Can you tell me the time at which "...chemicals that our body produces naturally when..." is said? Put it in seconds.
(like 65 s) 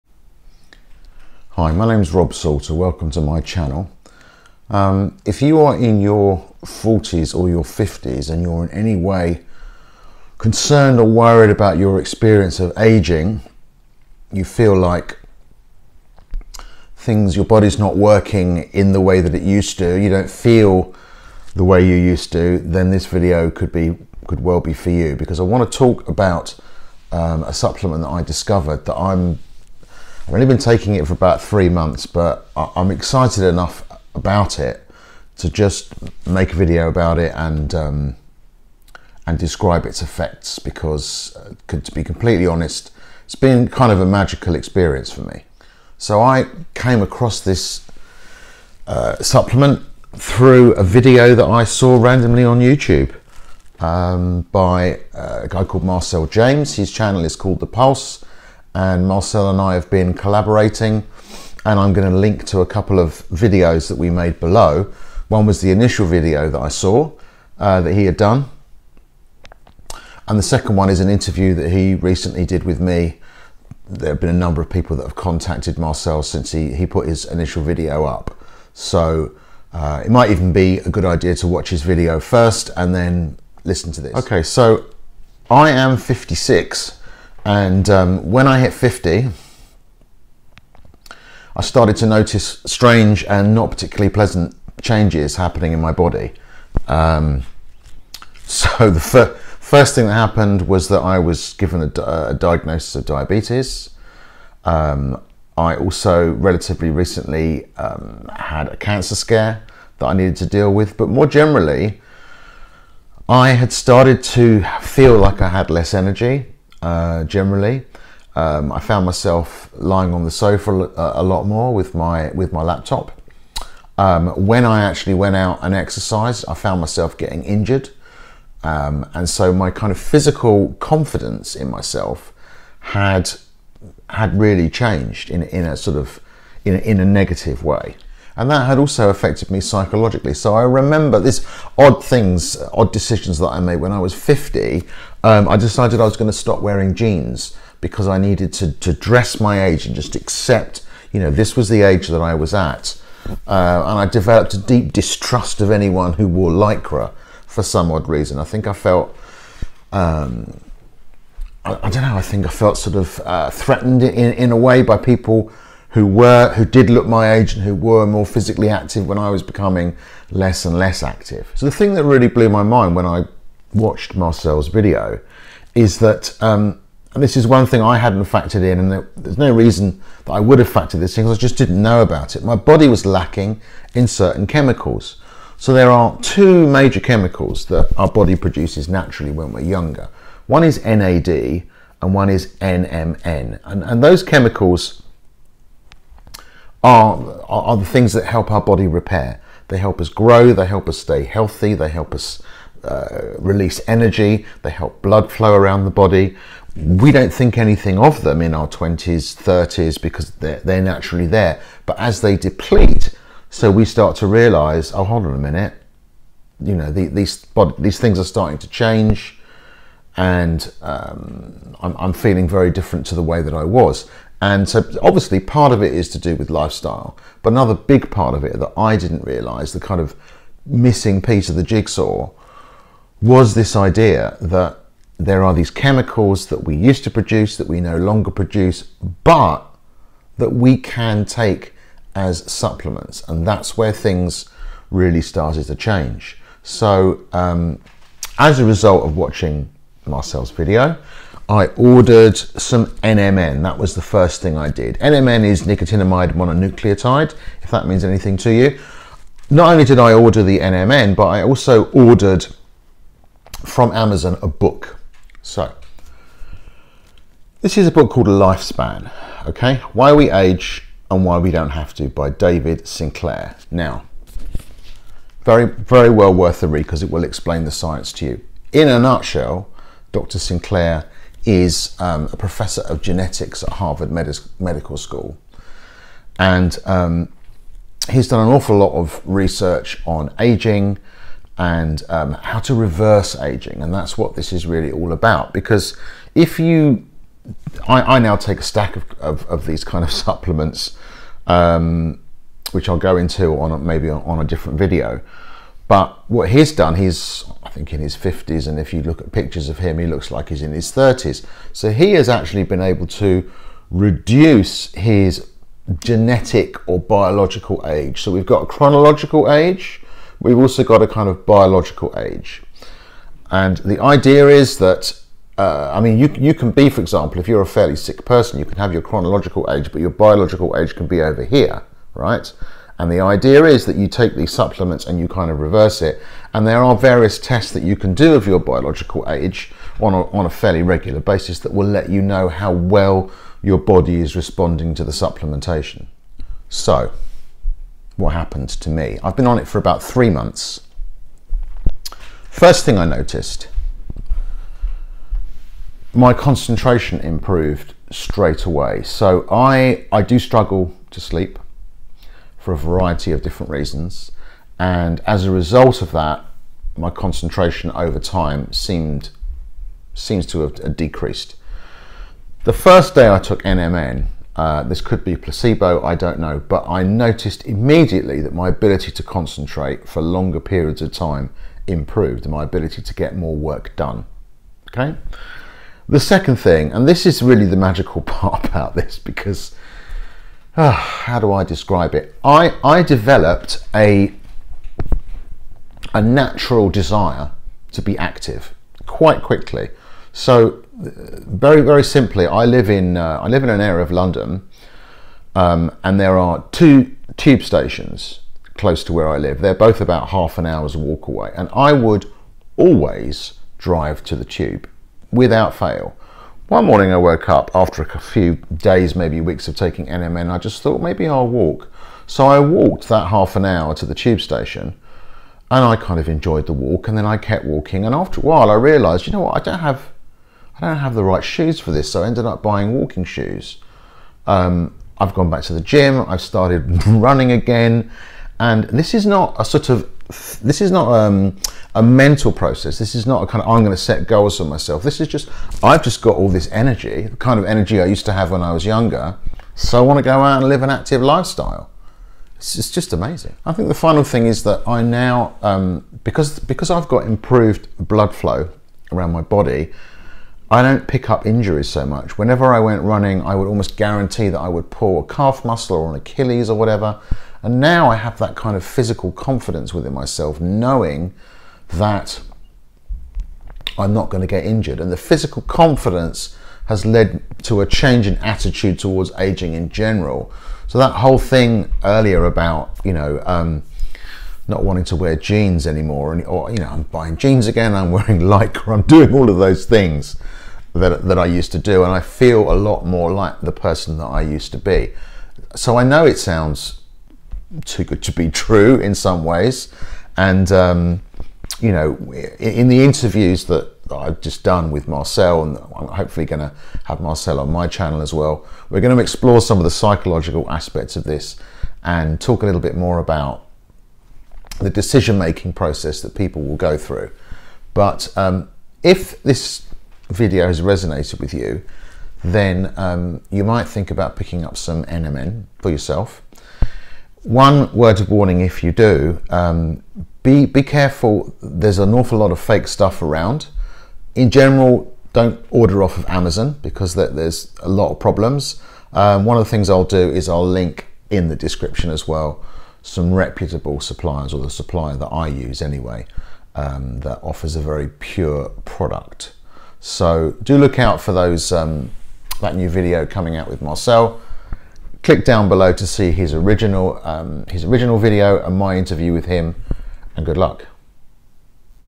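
186 s.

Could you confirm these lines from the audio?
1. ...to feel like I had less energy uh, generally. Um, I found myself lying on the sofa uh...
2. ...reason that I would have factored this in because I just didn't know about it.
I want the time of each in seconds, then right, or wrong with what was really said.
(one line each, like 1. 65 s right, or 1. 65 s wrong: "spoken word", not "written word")
1. 114 s right
2. 179 s right.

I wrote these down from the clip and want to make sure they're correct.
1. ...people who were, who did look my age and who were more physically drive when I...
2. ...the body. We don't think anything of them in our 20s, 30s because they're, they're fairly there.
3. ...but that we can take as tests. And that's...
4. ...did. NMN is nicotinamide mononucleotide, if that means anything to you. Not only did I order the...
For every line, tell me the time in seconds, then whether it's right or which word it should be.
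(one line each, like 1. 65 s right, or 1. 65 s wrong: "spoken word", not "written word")
1. 164 s wrong: "active", not "drive"
2. 205 s wrong: "naturally", not "fairly"
3. 239 s wrong: "supplements", not "tests"
4. 254 s right.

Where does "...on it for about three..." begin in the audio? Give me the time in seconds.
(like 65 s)
349 s.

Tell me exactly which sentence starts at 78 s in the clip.
So uh, it might even be a good idea to watch his video first and then listen to this.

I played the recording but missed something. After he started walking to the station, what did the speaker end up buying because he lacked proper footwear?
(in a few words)
Walking shoes.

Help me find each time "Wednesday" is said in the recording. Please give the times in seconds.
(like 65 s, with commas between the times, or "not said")
not said.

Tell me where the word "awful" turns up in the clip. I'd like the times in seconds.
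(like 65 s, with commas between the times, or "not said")
288 s, 532 s.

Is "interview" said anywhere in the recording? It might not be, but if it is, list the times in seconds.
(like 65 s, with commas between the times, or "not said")
71 s, 503 s, 558 s.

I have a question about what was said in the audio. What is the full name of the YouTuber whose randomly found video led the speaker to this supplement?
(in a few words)
Marcel James.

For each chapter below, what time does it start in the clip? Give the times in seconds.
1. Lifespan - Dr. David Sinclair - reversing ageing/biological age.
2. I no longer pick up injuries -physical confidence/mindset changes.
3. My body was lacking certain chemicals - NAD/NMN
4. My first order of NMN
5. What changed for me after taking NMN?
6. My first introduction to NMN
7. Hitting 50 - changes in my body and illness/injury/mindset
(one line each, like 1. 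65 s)
1. 265 s
2. 454 s
3. 183 s
4. 250 s
5. 348 s
6. 50 s
7. 89 s.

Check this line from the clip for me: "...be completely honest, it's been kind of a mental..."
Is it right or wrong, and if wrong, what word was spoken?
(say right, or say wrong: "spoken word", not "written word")
wrong: "magical", not "mental".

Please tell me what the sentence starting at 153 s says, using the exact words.
Uh, and I developed a deep distrust of anyone who wore lycra for some odd reason.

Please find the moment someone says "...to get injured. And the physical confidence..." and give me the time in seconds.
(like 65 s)
474 s.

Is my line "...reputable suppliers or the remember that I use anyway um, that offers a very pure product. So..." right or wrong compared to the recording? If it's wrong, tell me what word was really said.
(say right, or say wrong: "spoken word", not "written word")
wrong: "supplier", not "remember".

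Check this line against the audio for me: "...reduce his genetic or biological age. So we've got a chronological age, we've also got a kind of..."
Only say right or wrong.
right.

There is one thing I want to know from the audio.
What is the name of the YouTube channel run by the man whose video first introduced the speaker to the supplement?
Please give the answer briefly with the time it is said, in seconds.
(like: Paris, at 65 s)
The Pulse, at 57 s.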